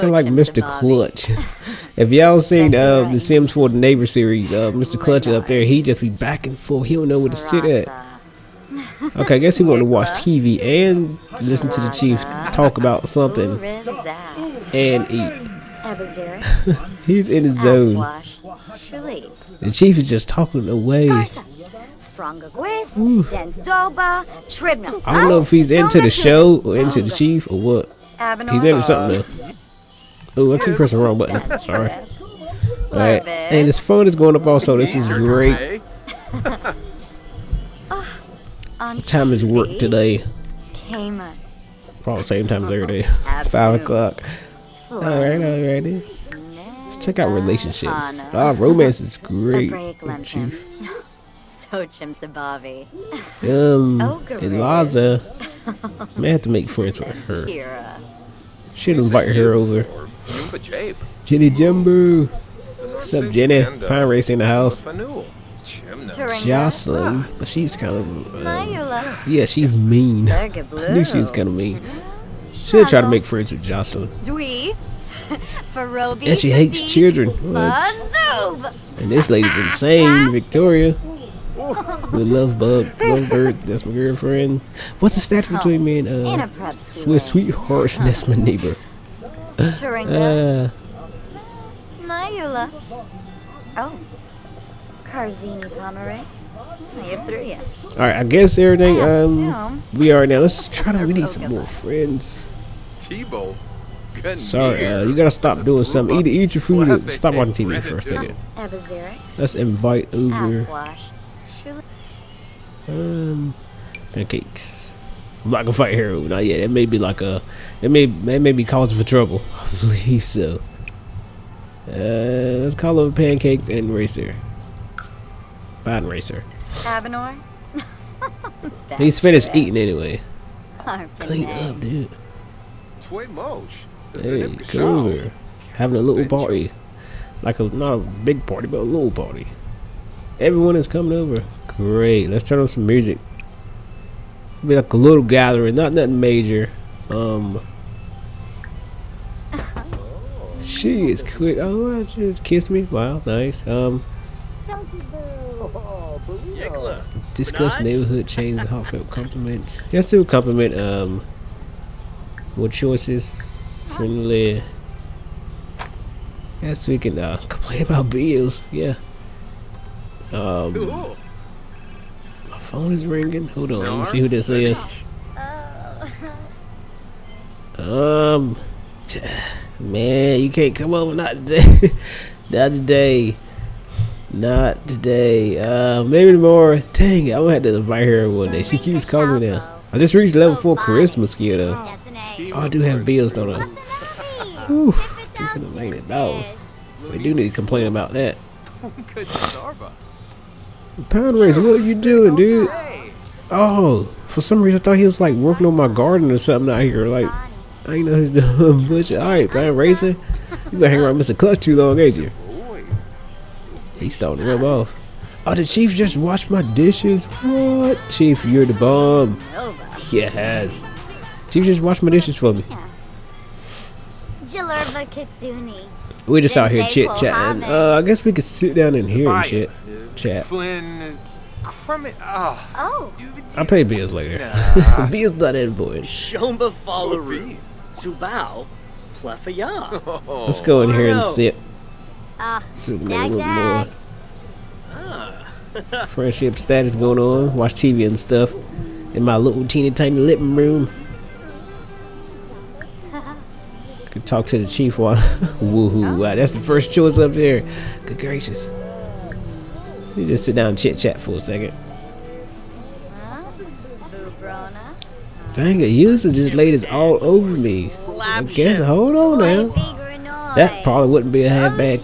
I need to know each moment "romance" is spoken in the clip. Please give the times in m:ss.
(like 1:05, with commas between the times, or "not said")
0:48.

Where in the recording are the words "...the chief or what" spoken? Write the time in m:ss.
0:27.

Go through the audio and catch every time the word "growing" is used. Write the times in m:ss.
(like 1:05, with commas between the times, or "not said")
not said.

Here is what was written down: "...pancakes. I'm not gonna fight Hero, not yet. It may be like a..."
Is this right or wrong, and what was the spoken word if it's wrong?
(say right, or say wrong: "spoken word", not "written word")
right.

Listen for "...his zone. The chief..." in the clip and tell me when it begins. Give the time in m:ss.
0:17.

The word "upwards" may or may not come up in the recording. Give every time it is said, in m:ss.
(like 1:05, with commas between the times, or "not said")
not said.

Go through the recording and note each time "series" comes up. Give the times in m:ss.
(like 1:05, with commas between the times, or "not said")
0:04.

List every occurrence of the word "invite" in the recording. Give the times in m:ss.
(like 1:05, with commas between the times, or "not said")
0:58, 1:49, 3:07.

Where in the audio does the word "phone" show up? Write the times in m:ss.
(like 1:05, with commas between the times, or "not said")
0:33, 2:52.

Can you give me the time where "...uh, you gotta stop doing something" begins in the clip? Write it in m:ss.
1:44.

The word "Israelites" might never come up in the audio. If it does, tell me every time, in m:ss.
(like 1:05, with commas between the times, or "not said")
not said.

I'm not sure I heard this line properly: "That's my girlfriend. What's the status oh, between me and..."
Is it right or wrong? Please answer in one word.
right.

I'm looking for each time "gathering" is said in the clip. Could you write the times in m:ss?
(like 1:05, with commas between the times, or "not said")
2:25.